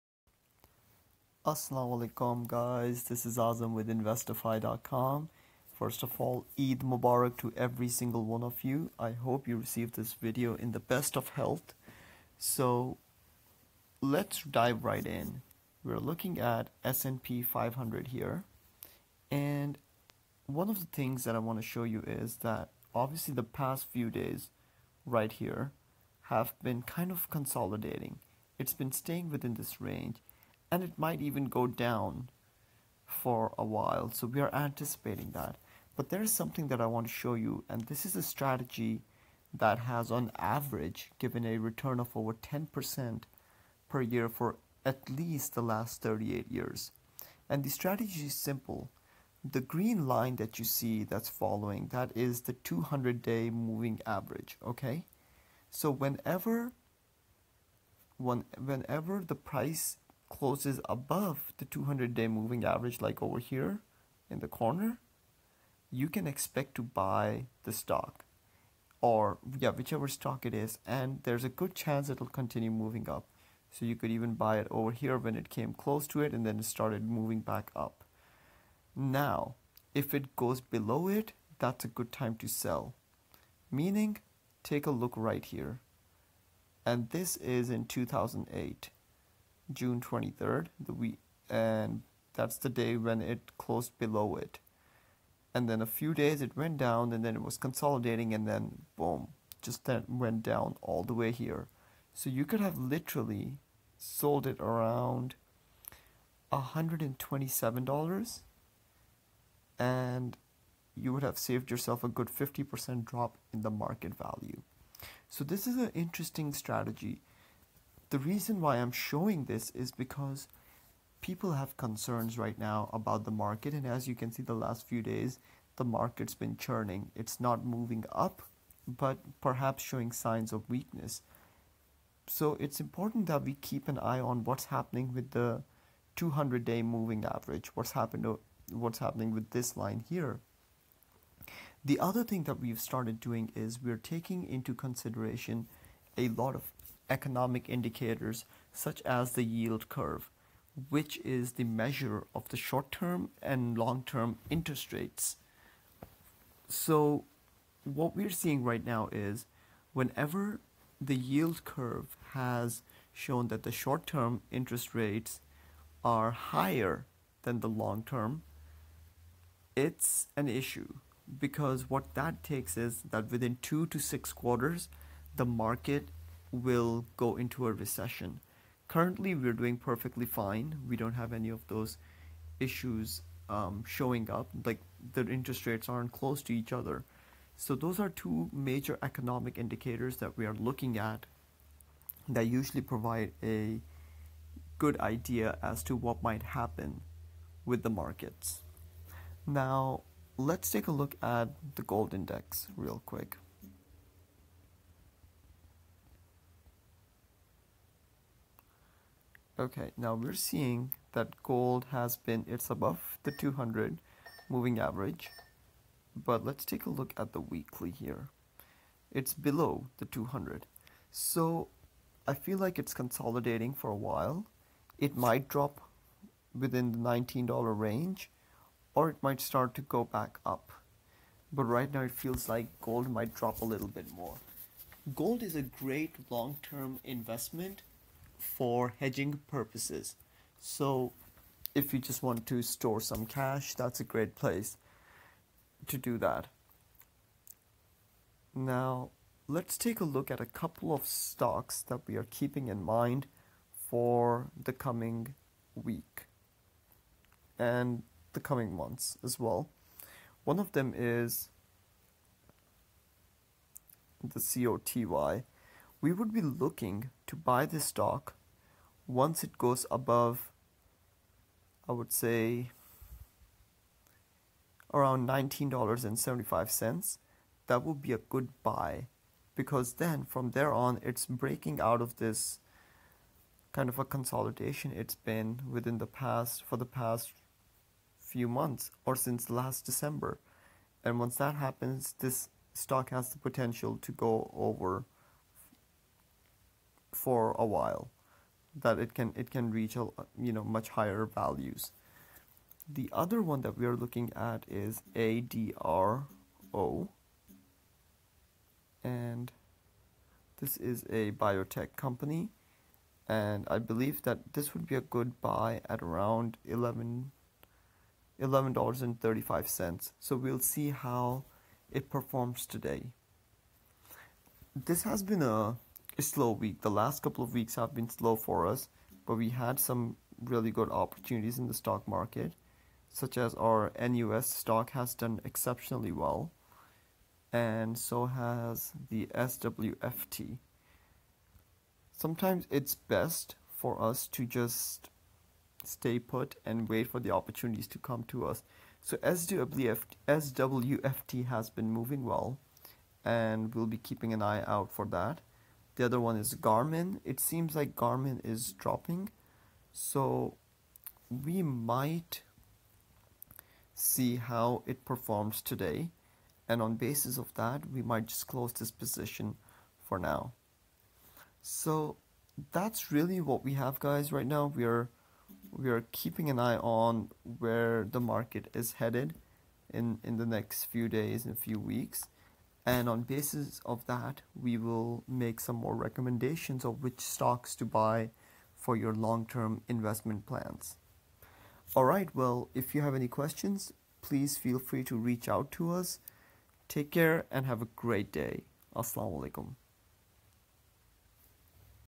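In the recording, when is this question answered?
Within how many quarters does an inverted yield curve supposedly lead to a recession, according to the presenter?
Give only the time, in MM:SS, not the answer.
02:53.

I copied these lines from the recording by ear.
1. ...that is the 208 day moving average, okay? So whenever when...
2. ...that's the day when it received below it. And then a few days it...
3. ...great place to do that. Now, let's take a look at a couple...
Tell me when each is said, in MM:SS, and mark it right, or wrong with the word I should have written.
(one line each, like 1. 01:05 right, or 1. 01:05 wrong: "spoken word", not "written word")
1. 00:51 wrong: "200", not "208"
2. 01:32 wrong: "closed", not "received"
3. 04:04 right.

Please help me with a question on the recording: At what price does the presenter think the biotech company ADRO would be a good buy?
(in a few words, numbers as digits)
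$11.35.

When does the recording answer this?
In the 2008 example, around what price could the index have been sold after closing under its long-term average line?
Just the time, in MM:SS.
01:46.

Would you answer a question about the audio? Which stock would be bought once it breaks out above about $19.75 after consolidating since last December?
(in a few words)
COTY.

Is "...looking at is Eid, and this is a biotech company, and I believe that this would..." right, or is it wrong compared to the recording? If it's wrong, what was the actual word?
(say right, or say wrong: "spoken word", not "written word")
wrong: "ADRO", not "Eid".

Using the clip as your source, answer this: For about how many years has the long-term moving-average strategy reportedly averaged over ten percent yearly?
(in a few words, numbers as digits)
38 years.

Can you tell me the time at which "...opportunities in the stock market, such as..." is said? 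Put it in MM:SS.
05:30.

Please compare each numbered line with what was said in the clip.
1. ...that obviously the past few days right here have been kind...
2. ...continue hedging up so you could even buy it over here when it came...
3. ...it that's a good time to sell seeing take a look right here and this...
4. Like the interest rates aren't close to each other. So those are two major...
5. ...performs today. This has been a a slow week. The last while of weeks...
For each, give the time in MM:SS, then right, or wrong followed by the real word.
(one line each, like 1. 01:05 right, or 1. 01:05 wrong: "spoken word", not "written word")
1. 00:22 right
2. 01:12 wrong: "moving", not "hedging"
3. 01:21 wrong: "meaning", not "seeing"
4. 03:04 right
5. 05:22 wrong: "couple", not "while".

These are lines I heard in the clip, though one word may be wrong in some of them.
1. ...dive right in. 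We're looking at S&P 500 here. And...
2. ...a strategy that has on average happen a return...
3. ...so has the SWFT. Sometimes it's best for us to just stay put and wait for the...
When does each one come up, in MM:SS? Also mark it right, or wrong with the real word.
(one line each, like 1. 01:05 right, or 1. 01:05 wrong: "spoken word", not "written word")
1. 00:14 right
2. 00:38 wrong: "given", not "happen"
3. 05:37 right.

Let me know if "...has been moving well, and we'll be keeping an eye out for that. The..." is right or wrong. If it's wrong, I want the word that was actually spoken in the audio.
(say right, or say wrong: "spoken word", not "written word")
right.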